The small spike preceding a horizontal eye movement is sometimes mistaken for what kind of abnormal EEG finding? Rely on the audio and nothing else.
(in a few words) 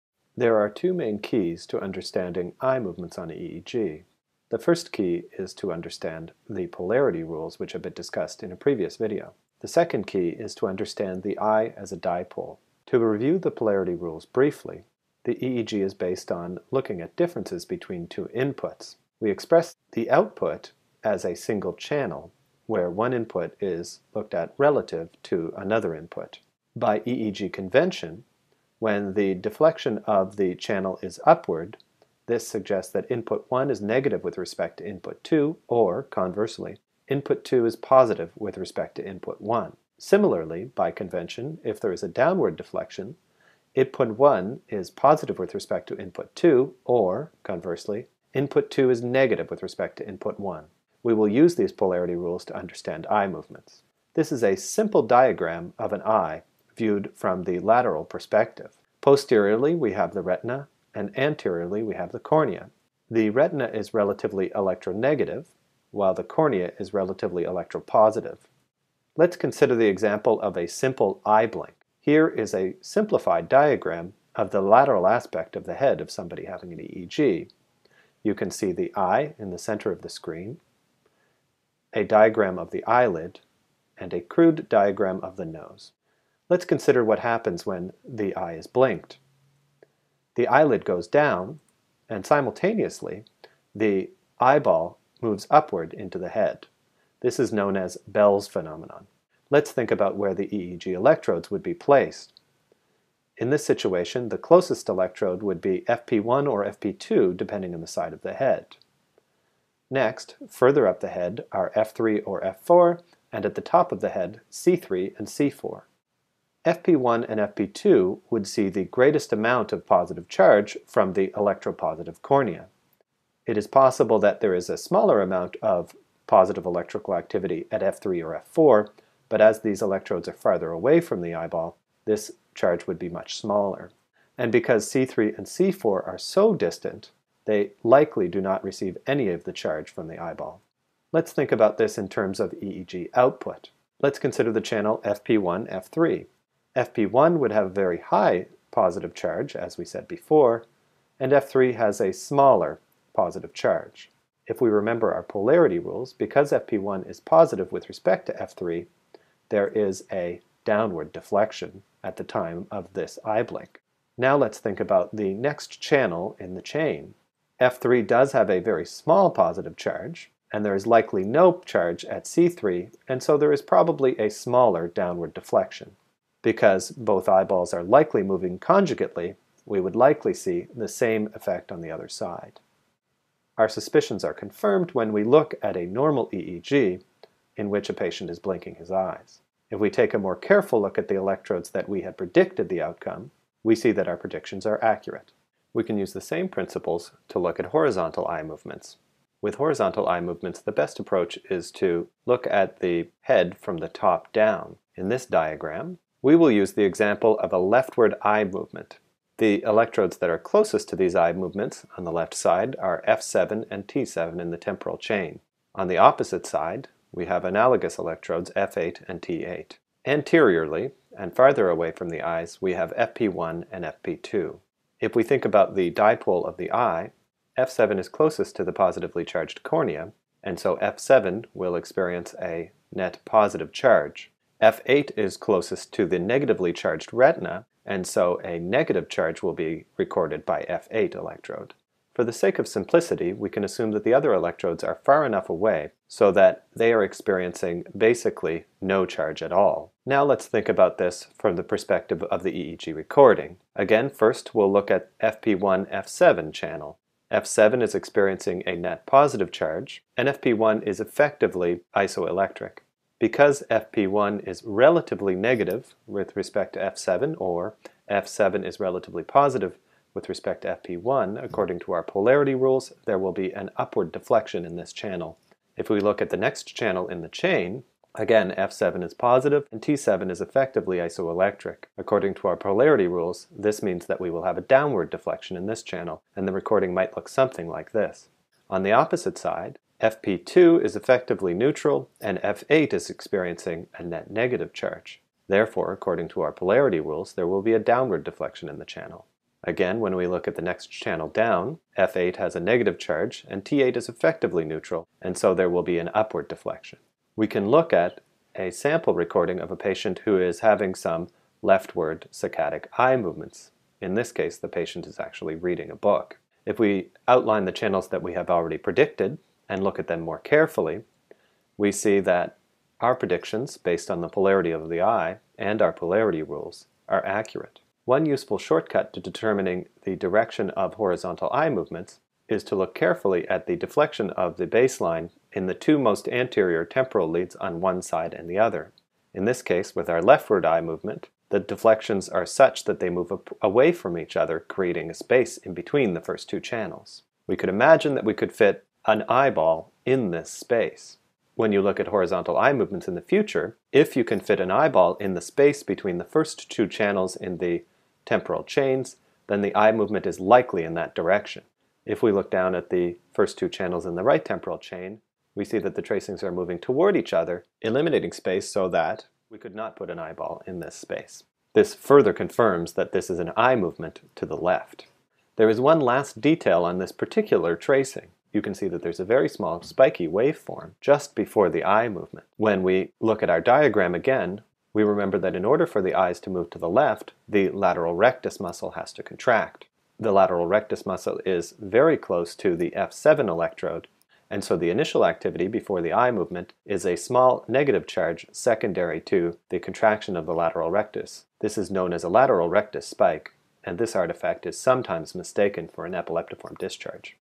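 epileptiform discharge.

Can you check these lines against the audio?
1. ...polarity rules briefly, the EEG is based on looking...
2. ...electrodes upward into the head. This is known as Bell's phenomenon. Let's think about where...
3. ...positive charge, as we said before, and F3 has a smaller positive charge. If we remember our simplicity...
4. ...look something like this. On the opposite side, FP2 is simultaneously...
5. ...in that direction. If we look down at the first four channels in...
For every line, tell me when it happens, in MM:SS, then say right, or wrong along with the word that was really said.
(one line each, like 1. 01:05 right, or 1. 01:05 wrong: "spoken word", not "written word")
1. 00:13 right
2. 01:35 wrong: "moves", not "electrodes"
3. 02:28 wrong: "polarity", not "simplicity"
4. 04:47 wrong: "effectively", not "simultaneously"
5. 06:00 wrong: "two", not "four".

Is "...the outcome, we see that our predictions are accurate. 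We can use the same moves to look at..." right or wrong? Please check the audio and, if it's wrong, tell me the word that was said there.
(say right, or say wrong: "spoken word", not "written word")
wrong: "principles", not "moves".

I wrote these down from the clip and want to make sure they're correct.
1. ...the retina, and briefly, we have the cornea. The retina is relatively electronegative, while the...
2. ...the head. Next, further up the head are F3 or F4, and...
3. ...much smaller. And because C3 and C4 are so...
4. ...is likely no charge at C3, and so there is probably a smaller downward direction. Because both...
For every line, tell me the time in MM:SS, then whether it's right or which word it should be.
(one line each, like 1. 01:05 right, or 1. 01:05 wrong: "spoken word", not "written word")
1. 01:00 wrong: "anteriorly", not "briefly"
2. 01:48 right
3. 02:13 right
4. 02:50 wrong: "deflection", not "direction".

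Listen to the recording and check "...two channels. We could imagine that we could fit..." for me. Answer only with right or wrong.
right.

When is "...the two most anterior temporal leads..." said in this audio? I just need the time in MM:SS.
05:35.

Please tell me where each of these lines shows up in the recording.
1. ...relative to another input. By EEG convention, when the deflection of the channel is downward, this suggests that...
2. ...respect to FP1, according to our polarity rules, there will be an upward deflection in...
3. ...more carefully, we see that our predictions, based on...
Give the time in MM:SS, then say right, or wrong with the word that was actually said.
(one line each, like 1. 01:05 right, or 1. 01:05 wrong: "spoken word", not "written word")
1. 00:24 wrong: "upward", not "downward"
2. 04:30 right
3. 05:20 right.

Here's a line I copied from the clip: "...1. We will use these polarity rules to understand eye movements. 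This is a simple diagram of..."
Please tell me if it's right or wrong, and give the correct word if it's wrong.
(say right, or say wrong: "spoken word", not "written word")
right.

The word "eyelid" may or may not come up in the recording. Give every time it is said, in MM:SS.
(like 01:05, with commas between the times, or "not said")
01:22, 01:30.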